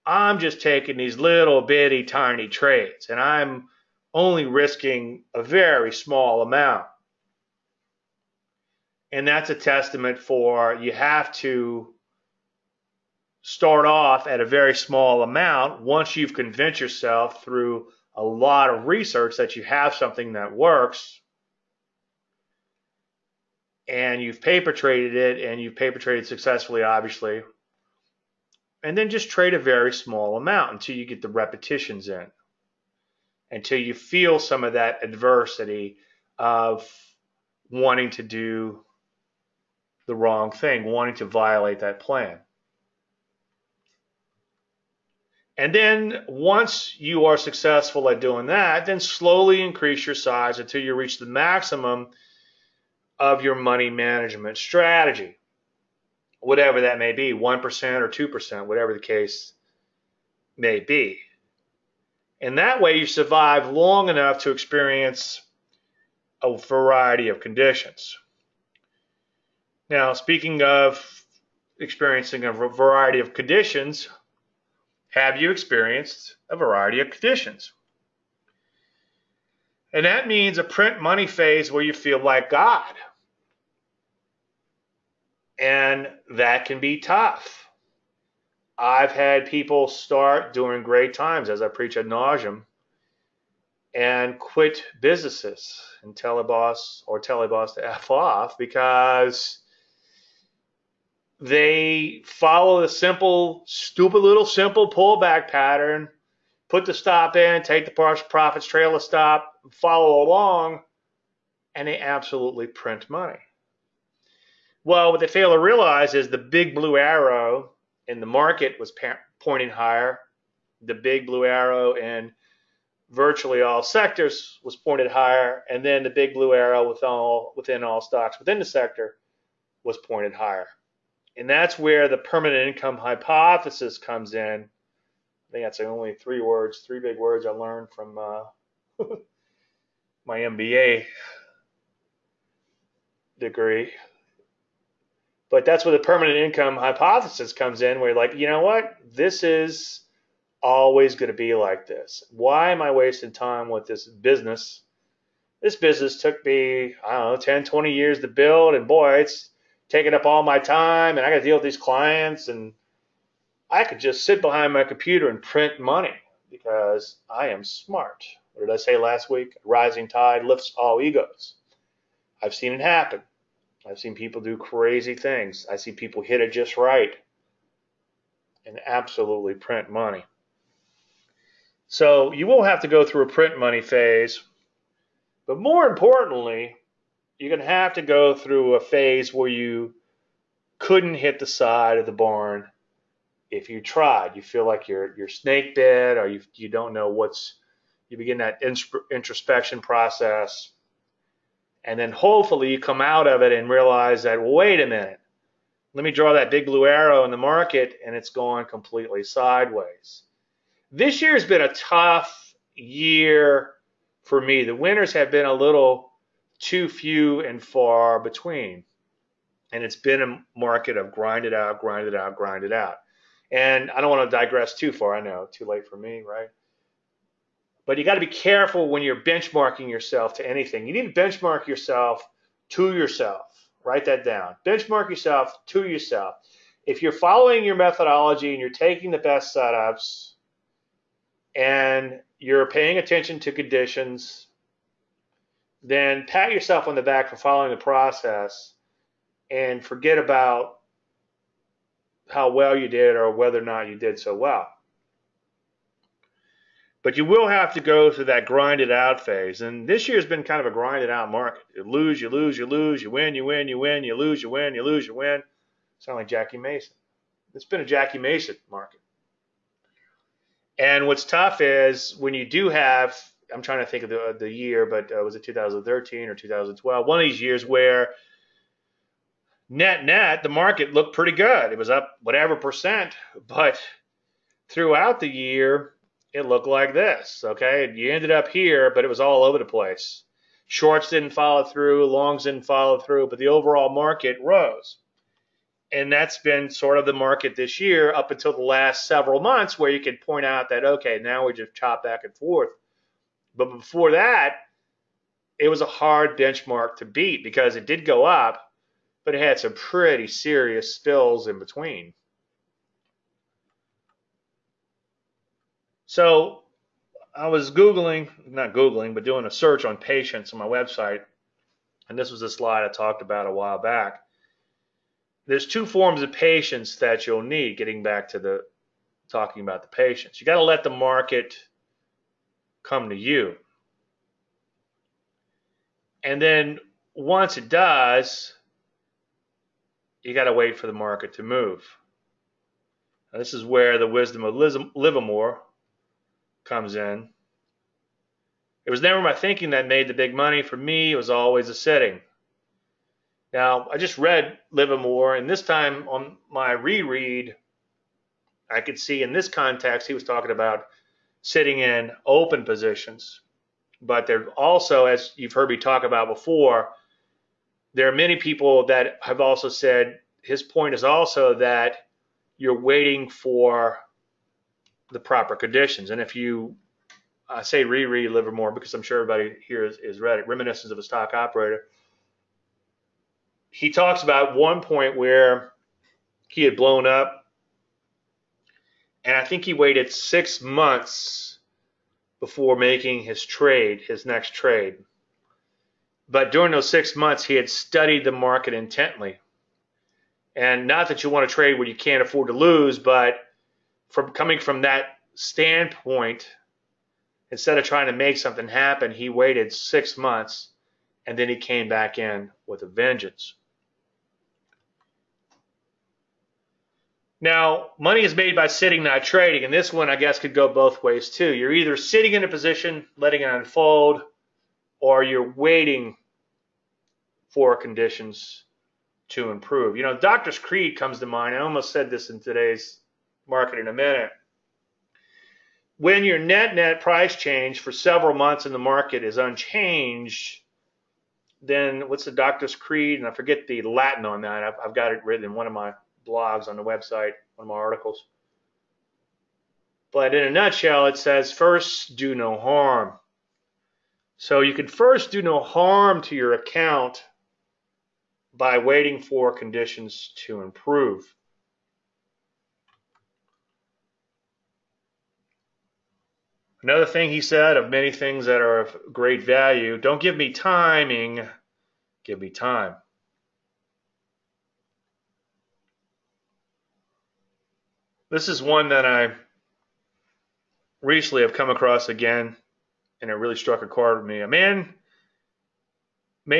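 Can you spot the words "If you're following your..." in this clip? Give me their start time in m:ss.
3:56.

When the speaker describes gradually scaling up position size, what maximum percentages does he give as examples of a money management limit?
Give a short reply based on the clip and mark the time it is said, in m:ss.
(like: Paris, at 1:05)
1% or 2%, at 0:57.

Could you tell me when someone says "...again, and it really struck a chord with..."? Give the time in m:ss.
8:02.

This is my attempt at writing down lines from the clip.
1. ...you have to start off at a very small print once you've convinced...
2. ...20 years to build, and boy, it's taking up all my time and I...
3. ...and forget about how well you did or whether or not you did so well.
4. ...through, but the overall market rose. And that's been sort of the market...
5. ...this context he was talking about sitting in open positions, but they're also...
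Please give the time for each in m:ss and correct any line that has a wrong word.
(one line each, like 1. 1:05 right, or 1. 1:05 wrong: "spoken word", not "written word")
1. 0:10 wrong: "amount", not "print"
2. 2:37 right
3. 4:09 right
4. 4:52 right
5. 5:59 right.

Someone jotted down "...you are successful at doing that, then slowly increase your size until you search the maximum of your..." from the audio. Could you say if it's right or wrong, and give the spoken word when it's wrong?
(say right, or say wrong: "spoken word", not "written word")
wrong: "reach", not "search".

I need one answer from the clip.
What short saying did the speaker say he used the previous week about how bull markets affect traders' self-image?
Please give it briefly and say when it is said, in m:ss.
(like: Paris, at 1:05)
Rising tide lifts all egos, at 2:49.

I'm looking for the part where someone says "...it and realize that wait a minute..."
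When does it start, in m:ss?
3:23.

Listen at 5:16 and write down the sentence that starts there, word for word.
So I was Googling, not Googling, but doing a search on patients on my website.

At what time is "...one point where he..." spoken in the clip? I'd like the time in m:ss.
6:24.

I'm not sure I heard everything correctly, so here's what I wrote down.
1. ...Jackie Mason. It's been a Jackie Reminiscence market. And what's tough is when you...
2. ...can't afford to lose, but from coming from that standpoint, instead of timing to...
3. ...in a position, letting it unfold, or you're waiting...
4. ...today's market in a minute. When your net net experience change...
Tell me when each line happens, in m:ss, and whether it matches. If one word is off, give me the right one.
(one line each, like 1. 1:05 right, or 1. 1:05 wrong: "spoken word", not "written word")
1. 4:26 wrong: "Mason", not "Reminiscence"
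2. 6:41 wrong: "trying", not "timing"
3. 7:02 right
4. 7:12 wrong: "price", not "experience".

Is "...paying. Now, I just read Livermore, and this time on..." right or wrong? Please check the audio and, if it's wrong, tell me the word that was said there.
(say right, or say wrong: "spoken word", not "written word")
wrong: "setting", not "paying".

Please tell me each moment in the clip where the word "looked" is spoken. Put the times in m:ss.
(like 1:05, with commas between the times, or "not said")
4:40, 4:46.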